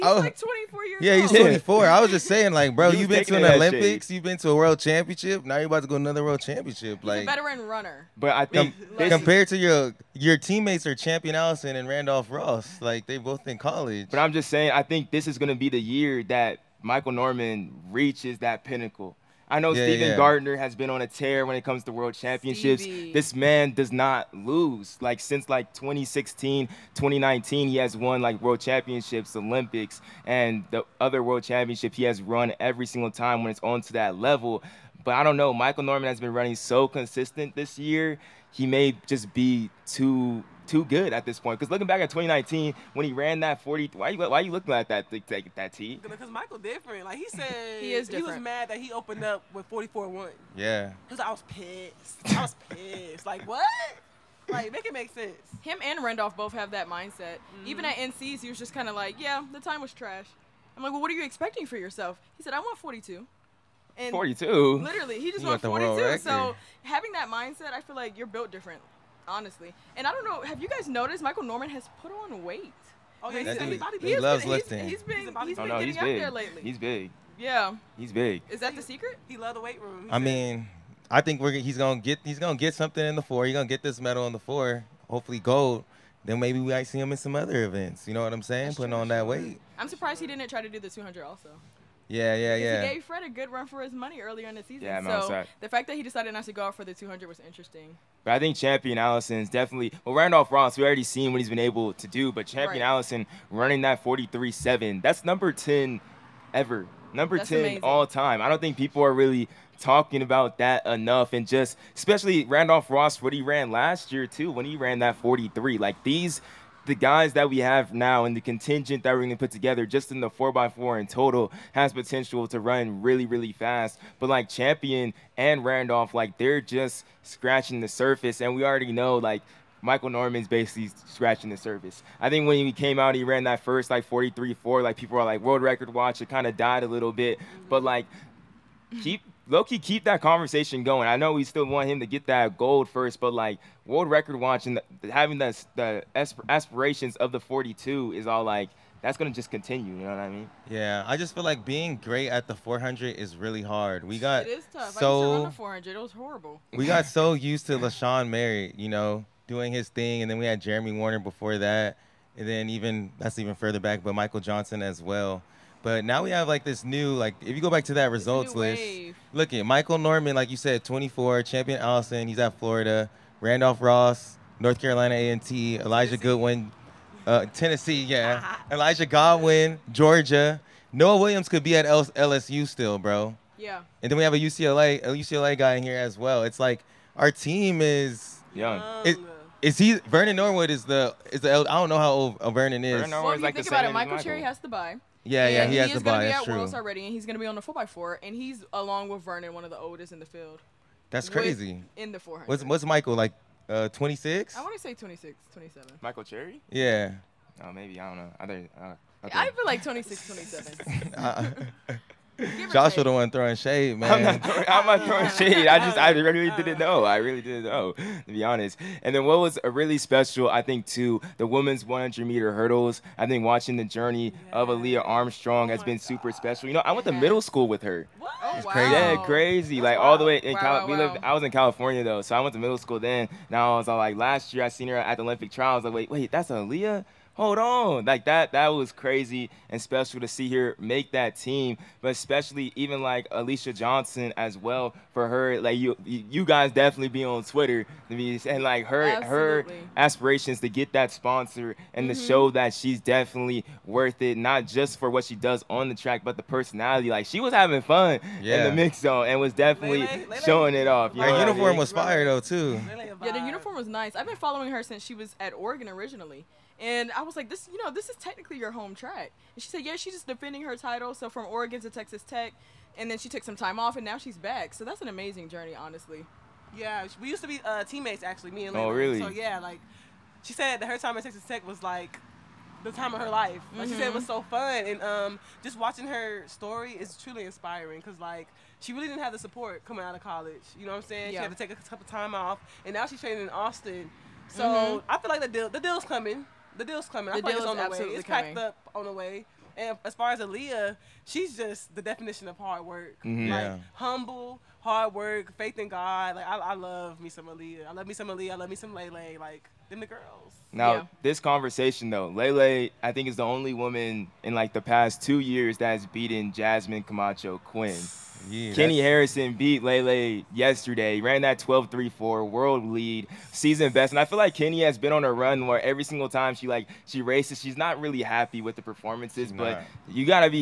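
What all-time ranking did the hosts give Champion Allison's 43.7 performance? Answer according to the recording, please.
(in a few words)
Number 10.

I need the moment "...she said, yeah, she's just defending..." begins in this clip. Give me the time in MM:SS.
04:29.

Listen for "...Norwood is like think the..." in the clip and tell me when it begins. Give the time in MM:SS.
03:13.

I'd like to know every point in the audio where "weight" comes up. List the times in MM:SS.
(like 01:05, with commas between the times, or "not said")
01:12, 01:19, 01:29.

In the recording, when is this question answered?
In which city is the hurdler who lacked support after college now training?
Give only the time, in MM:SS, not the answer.
04:53.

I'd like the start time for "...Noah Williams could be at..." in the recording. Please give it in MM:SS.
03:00.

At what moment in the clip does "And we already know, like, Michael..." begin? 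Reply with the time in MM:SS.
02:08.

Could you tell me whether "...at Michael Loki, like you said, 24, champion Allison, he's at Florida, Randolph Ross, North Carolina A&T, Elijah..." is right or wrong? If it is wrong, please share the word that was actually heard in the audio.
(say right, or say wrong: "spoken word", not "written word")
wrong: "Norman", not "Loki".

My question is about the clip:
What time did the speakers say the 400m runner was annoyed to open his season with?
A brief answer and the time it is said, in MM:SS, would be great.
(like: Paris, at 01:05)
44.1, at 00:49.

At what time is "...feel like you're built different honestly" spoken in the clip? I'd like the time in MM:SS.
01:07.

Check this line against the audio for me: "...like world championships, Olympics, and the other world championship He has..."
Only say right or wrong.
right.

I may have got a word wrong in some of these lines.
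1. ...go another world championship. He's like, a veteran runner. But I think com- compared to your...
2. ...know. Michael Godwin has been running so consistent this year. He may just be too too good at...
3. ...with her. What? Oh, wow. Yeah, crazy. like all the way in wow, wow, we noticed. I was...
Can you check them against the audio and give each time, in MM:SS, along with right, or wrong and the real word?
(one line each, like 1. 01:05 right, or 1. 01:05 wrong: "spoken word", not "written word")
1. 00:05 right
2. 00:35 wrong: "Norman", not "Godwin"
3. 03:47 wrong: "lived", not "noticed".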